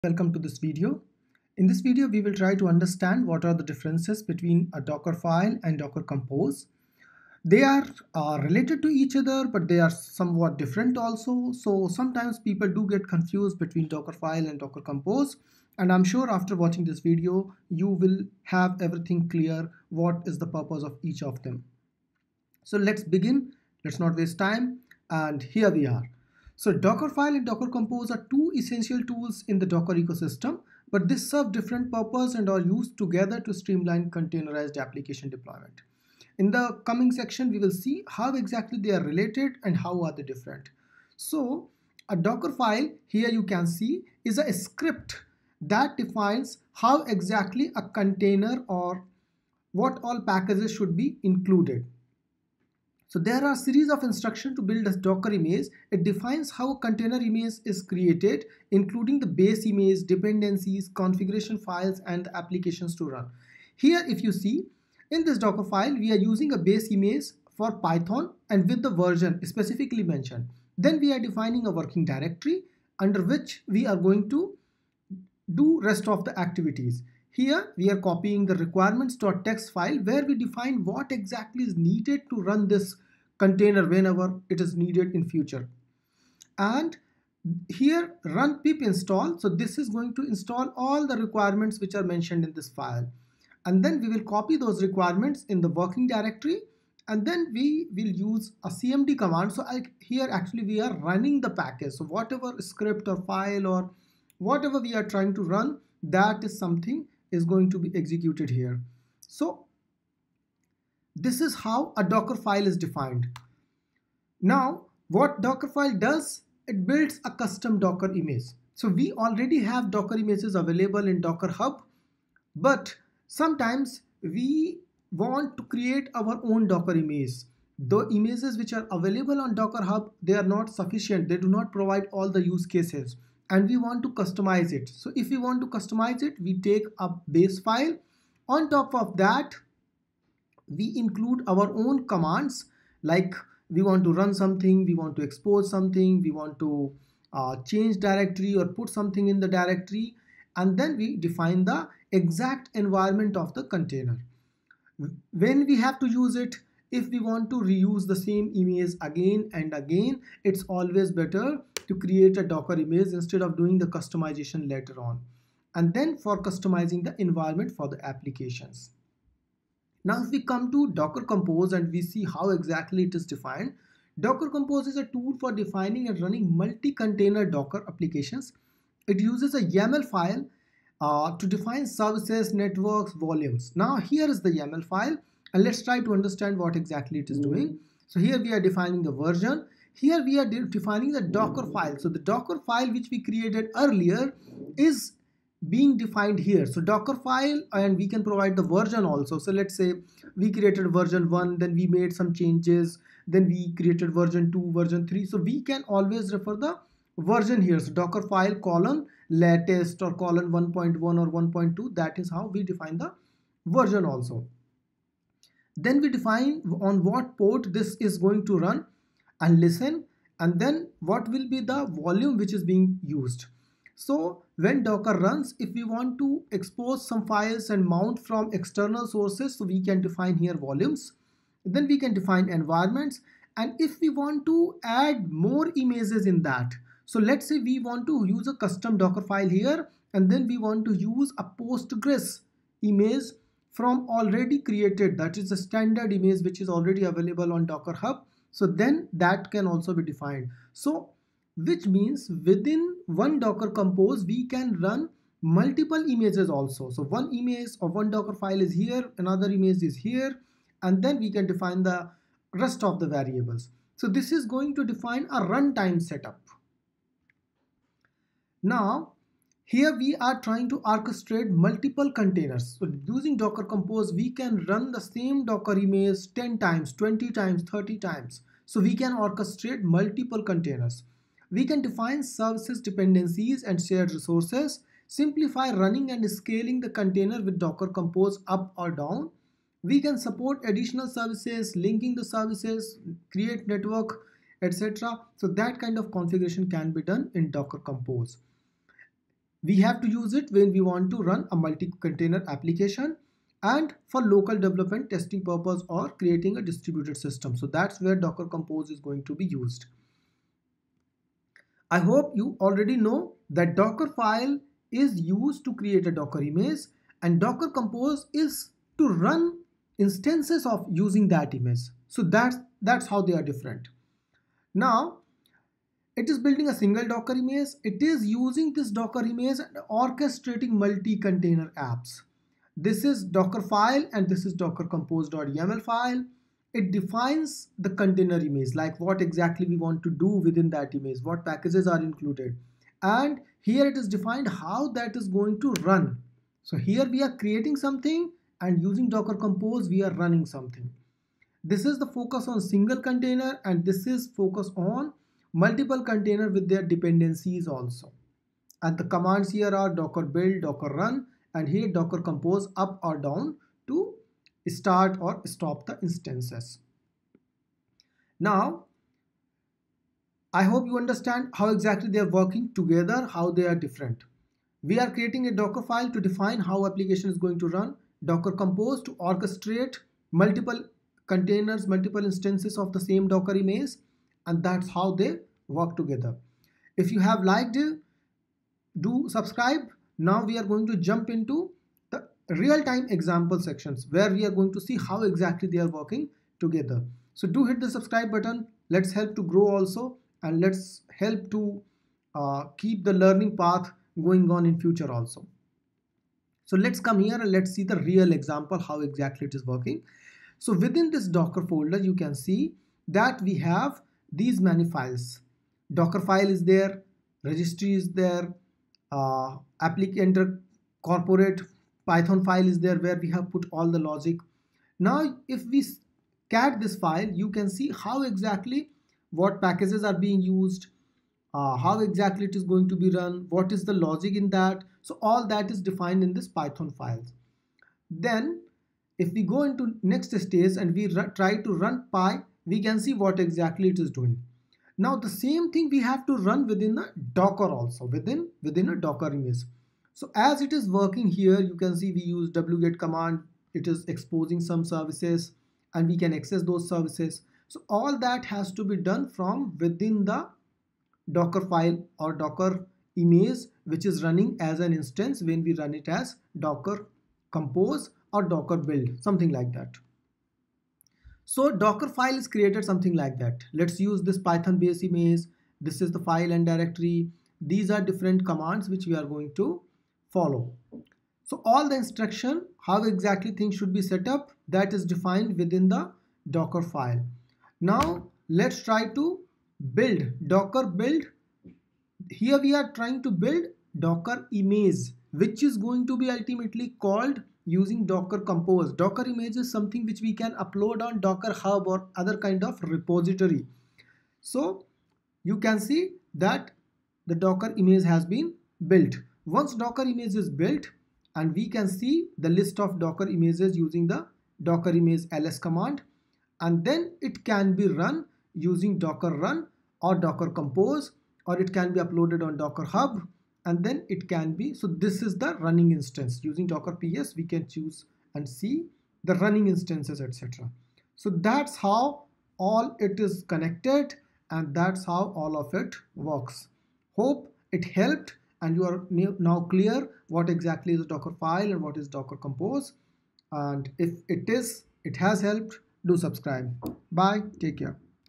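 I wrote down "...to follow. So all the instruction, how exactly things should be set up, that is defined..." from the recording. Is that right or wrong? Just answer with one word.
right.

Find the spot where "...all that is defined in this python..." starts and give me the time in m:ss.
7:15.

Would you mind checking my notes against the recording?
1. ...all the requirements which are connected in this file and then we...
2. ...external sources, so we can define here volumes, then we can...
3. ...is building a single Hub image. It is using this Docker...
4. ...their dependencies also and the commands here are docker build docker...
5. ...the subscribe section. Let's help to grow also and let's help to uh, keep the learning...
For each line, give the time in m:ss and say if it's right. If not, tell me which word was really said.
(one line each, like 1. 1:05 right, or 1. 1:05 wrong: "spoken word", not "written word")
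1. 1:30 wrong: "mentioned", not "connected"
2. 3:48 right
3. 5:26 wrong: "Docker", not "Hub"
4. 5:56 right
5. 6:37 wrong: "button", not "section".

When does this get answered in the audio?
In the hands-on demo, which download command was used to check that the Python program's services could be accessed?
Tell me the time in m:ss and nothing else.
7:32.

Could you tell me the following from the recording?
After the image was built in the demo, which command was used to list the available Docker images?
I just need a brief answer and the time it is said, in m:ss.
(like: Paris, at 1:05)
docker image ls, at 8:34.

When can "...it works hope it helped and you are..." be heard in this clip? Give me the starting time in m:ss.
8:55.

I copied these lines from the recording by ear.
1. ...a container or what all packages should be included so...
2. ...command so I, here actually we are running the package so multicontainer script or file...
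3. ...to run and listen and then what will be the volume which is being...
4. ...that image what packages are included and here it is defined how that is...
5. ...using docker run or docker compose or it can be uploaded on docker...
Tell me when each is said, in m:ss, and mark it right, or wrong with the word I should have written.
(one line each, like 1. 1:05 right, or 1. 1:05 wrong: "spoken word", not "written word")
1. 0:47 right
2. 1:39 wrong: "whatever", not "multicontainer"
3. 3:38 right
4. 5:40 right
5. 8:38 right.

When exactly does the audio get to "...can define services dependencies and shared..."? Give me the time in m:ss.
4:41.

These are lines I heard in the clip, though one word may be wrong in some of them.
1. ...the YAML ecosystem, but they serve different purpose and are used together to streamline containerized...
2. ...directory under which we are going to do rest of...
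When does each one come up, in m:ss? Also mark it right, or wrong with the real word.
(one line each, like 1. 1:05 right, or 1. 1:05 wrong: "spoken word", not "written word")
1. 0:29 wrong: "Docker", not "YAML"
2. 1:12 right.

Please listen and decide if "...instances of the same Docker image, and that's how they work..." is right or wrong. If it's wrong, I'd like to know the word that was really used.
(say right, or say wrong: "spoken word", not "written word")
right.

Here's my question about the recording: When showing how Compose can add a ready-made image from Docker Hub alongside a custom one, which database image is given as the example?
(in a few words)
Postgres.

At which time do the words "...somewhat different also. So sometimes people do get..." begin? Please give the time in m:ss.
0:09.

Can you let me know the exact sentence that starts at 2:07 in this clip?
The images which are available on Docker Hub, they are not sufficient.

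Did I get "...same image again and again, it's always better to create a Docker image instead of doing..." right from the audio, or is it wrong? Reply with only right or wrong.
right.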